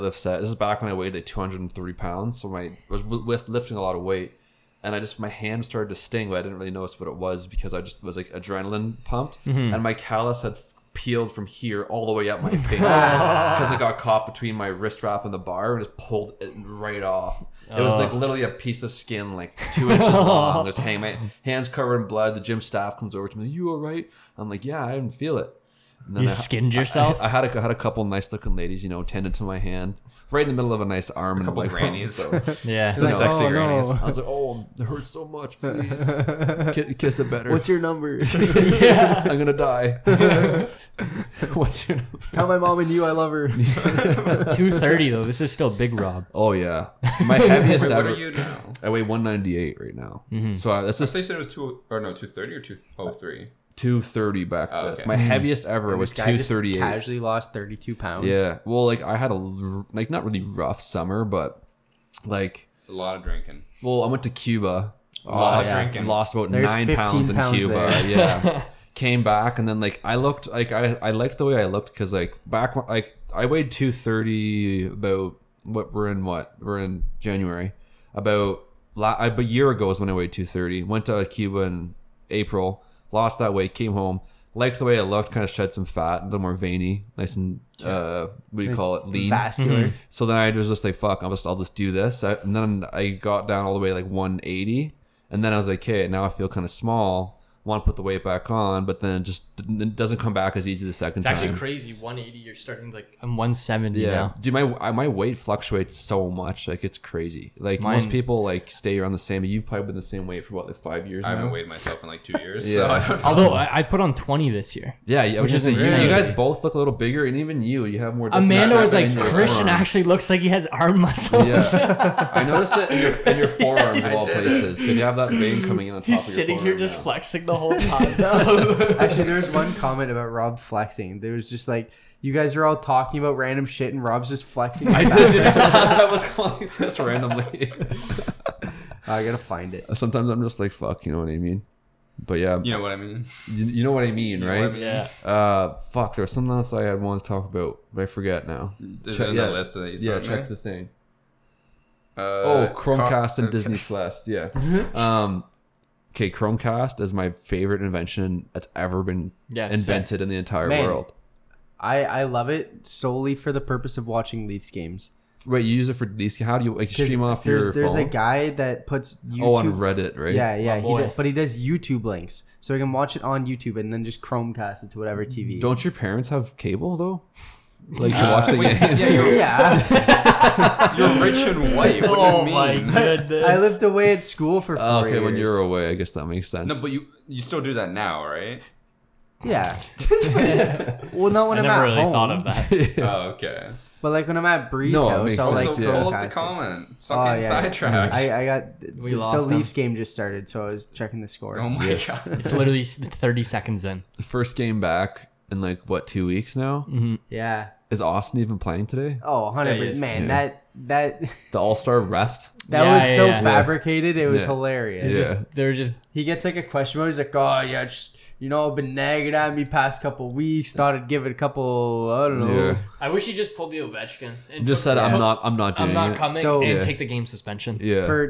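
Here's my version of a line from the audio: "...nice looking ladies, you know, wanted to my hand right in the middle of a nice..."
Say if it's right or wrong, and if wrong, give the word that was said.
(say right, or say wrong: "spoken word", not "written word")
wrong: "tended", not "wanted".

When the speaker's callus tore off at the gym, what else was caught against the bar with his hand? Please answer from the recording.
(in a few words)
wrist wrap.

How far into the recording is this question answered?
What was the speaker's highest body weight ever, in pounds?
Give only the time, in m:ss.
0:56.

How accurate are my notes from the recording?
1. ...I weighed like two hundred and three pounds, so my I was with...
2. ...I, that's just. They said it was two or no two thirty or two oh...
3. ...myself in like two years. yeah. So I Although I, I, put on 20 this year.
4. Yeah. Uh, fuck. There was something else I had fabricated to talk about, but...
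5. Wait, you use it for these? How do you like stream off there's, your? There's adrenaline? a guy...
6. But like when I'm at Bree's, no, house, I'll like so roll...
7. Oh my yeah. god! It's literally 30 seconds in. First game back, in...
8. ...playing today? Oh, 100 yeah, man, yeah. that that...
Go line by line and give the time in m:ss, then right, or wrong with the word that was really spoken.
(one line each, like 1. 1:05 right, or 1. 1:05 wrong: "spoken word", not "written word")
1. 0:00 right
2. 0:50 right
3. 1:51 right
4. 2:24 wrong: "wanted", not "fabricated"
5. 2:45 wrong: "phone", not "adrenaline"
6. 3:13 right
7. 3:21 right
8. 3:28 right.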